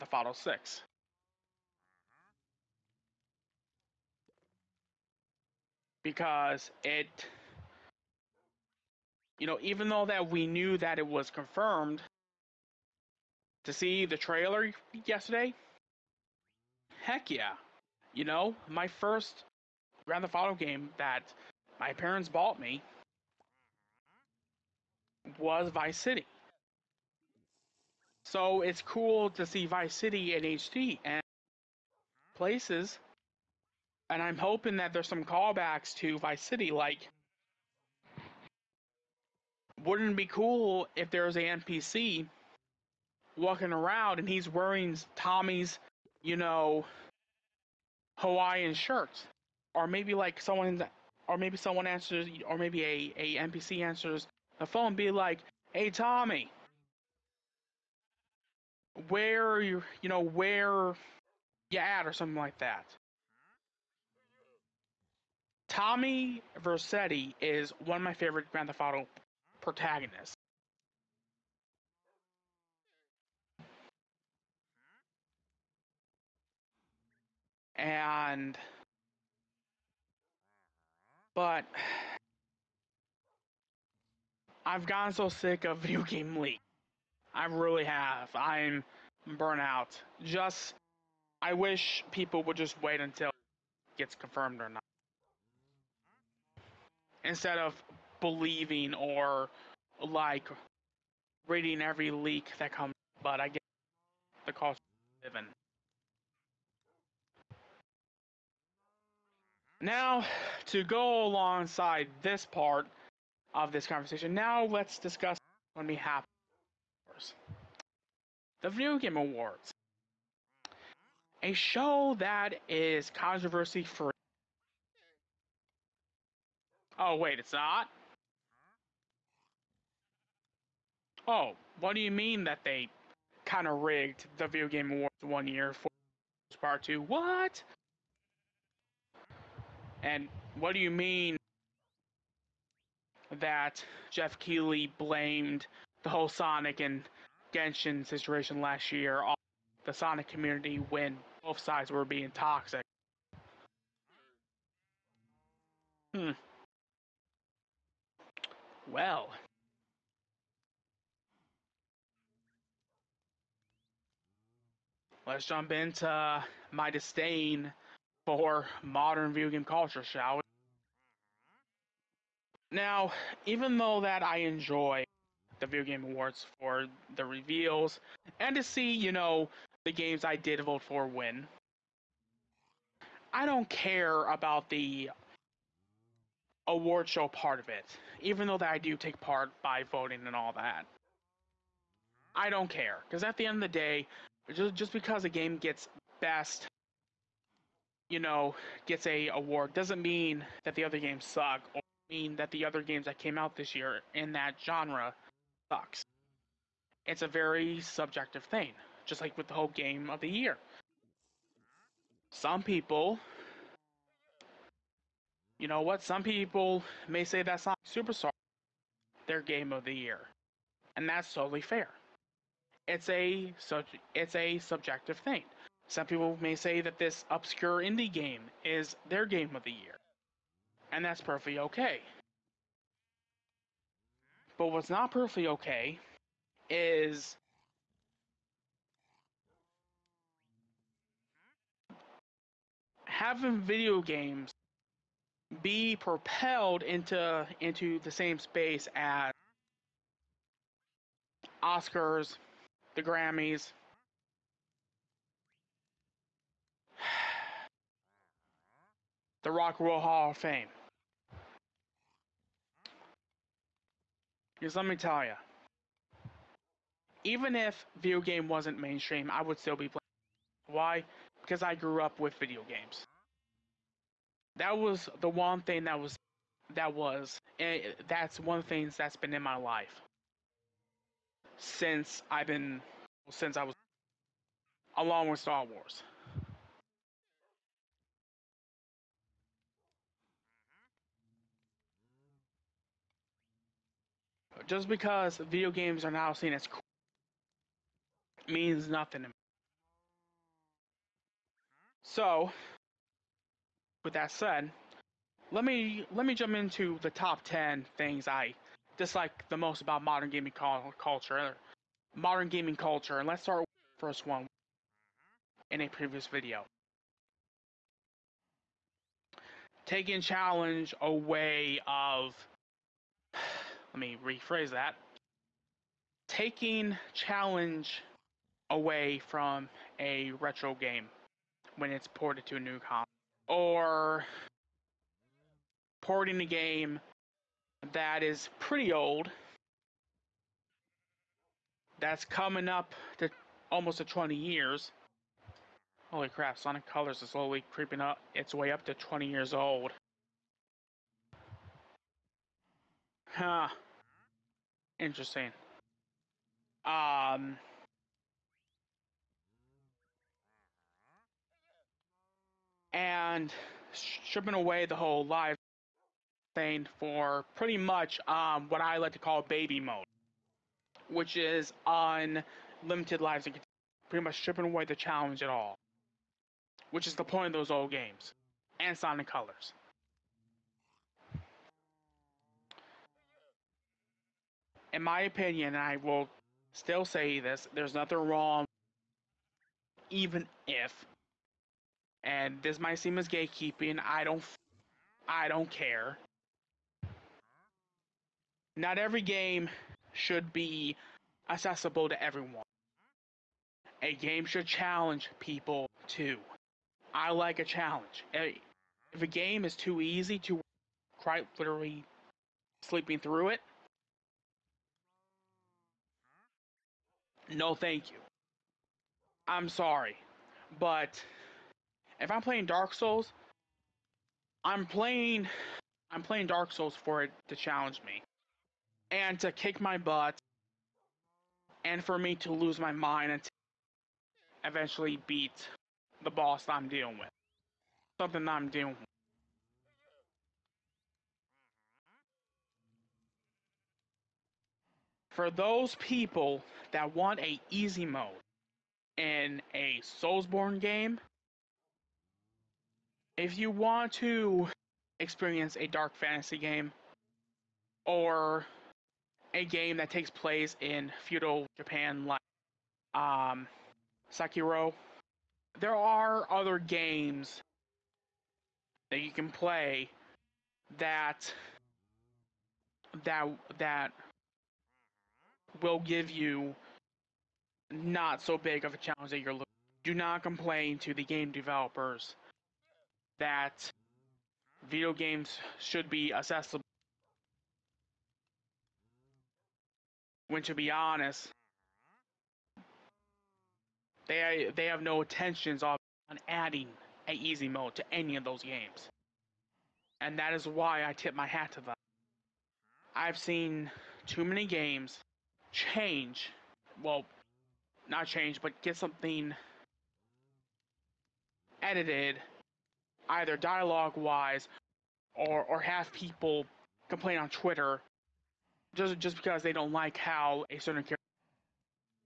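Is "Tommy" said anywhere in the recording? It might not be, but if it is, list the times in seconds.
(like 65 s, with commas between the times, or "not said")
45 s, 55 s, 65 s.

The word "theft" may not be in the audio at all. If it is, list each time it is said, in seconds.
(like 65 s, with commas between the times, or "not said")
0 s, 20 s, 68 s.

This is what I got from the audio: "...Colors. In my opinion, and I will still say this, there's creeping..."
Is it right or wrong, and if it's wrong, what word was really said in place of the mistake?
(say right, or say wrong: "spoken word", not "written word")
wrong: "nothing", not "creeping".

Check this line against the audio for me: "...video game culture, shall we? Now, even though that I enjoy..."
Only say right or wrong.
right.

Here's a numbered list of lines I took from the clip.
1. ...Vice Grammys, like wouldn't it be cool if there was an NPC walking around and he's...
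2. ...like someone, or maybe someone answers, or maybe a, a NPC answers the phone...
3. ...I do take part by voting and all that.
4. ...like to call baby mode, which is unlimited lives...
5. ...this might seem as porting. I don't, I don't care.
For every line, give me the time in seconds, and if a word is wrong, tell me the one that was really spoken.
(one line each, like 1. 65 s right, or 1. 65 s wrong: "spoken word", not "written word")
1. 36 s wrong: "City", not "Grammys"
2. 50 s right
3. 188 s right
4. 368 s right
5. 392 s wrong: "gatekeeping", not "porting".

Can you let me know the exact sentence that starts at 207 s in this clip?
It's a very subjective thing, just like with the whole game of the year.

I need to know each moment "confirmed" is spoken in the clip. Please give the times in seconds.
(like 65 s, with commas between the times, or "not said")
11 s, 94 s.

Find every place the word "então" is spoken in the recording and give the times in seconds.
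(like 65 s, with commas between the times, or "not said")
not said.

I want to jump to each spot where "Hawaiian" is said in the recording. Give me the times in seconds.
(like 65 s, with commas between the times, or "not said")
48 s.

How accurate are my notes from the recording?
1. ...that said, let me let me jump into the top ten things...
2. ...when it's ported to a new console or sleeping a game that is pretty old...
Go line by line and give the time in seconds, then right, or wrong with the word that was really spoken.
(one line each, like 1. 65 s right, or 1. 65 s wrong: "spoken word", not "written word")
1. 304 s right
2. 331 s wrong: "porting", not "sleeping".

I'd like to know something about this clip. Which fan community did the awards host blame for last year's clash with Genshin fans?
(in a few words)
Sonic community.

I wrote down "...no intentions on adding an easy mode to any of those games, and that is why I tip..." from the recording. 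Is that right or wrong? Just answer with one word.
right.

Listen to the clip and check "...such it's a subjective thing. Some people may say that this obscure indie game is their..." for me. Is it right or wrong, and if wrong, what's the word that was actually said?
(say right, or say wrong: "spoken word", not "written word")
right.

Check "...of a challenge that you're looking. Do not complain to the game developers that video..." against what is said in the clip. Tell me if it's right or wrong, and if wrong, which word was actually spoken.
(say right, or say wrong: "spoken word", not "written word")
right.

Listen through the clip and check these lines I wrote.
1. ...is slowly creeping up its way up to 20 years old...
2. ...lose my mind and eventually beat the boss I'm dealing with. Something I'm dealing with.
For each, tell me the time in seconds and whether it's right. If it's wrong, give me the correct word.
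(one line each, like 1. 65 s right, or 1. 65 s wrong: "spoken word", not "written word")
1. 347 s right
2. 432 s right.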